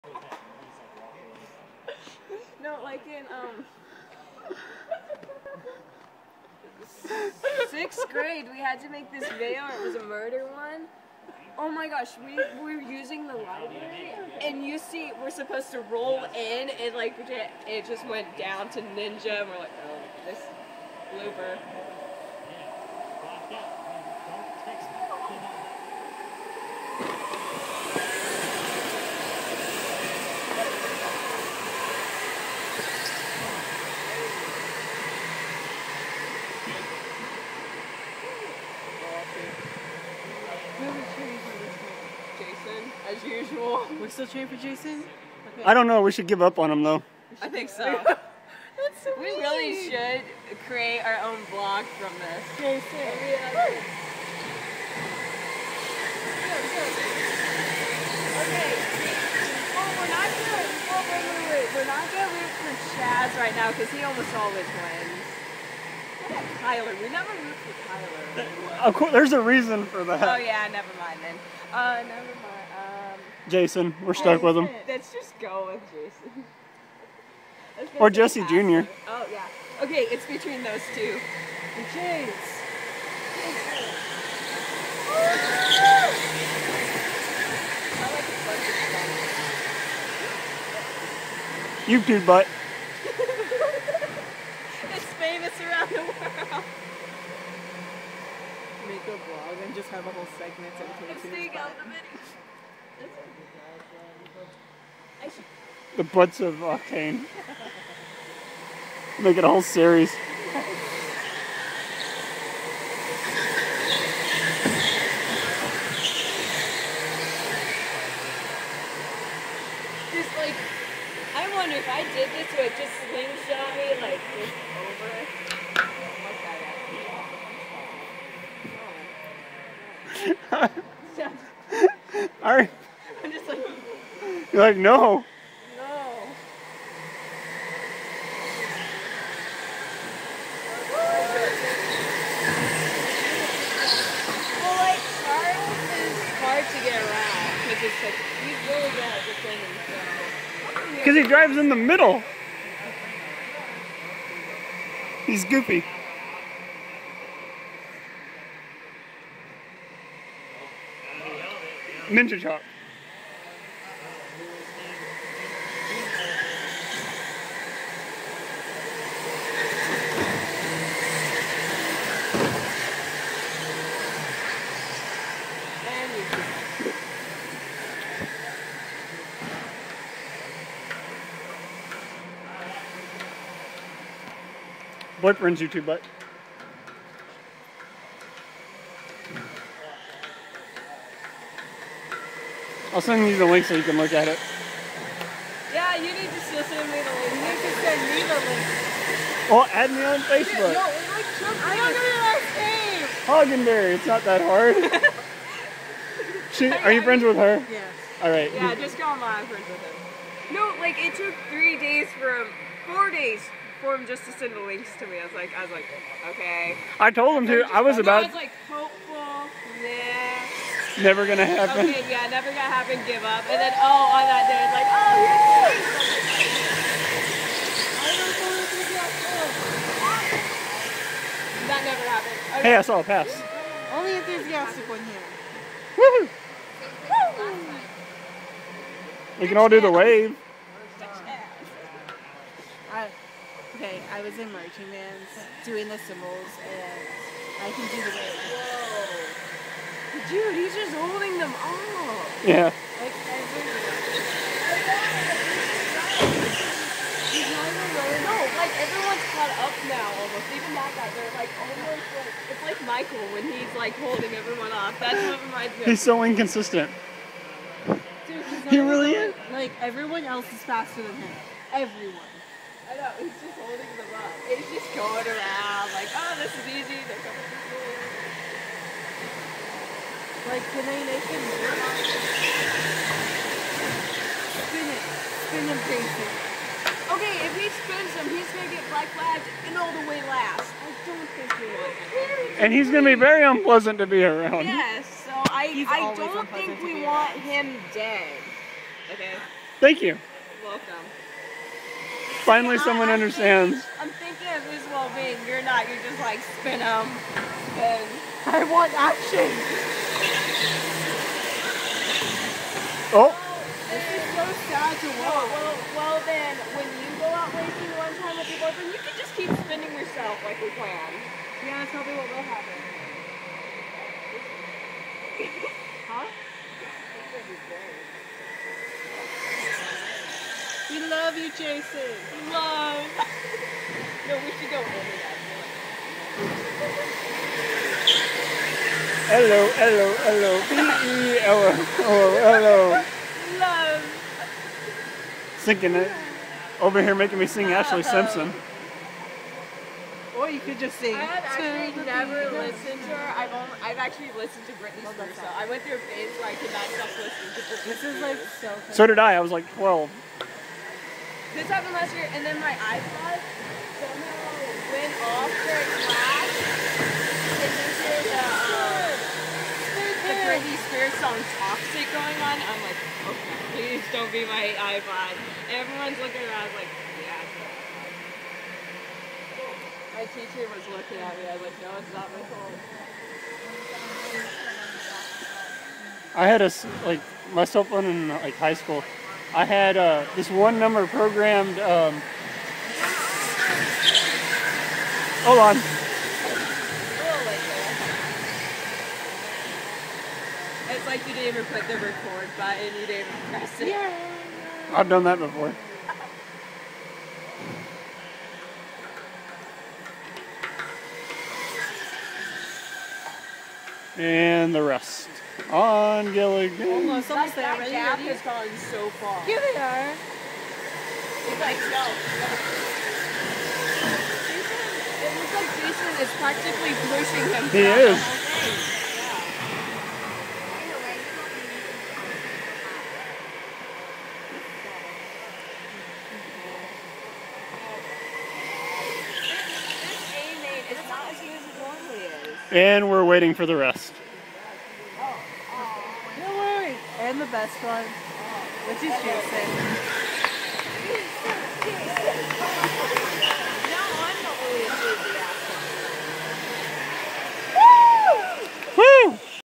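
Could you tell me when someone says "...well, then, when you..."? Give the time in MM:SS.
05:15.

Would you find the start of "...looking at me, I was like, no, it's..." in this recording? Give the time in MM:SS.
06:20.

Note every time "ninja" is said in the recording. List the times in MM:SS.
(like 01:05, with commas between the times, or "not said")
00:18, 02:42.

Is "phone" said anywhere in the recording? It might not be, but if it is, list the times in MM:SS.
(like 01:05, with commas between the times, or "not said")
06:22, 06:27.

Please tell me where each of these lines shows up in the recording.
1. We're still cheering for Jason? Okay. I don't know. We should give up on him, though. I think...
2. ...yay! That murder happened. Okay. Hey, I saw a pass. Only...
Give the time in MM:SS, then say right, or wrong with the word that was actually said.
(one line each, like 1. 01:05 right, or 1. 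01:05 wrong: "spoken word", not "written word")
1. 00:43 right
2. 03:45 wrong: "never", not "murder".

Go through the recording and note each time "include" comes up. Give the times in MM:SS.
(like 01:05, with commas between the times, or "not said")
not said.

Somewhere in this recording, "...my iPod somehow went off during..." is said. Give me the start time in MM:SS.
06:02.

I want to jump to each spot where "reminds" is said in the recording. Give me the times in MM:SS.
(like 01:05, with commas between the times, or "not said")
04:25.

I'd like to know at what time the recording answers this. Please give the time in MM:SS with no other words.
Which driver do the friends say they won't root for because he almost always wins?
01:02.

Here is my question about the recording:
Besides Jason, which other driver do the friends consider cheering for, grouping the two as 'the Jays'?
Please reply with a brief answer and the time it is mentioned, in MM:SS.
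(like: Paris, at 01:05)
Jesse Jr., at 01:18.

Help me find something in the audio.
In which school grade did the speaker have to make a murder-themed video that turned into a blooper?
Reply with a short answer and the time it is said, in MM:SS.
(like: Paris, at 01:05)
Sixth grade, at 00:07.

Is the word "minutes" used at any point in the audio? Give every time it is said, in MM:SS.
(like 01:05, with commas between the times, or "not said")
01:41.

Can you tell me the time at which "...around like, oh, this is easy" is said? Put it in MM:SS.
04:35.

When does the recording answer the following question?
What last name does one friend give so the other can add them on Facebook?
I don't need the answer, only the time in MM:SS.
03:23.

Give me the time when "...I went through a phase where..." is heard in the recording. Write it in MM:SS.
05:55.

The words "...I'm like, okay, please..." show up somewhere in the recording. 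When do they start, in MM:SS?
06:12.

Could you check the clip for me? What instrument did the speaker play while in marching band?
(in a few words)
Cymbals.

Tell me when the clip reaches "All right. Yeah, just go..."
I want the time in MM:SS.
03:28.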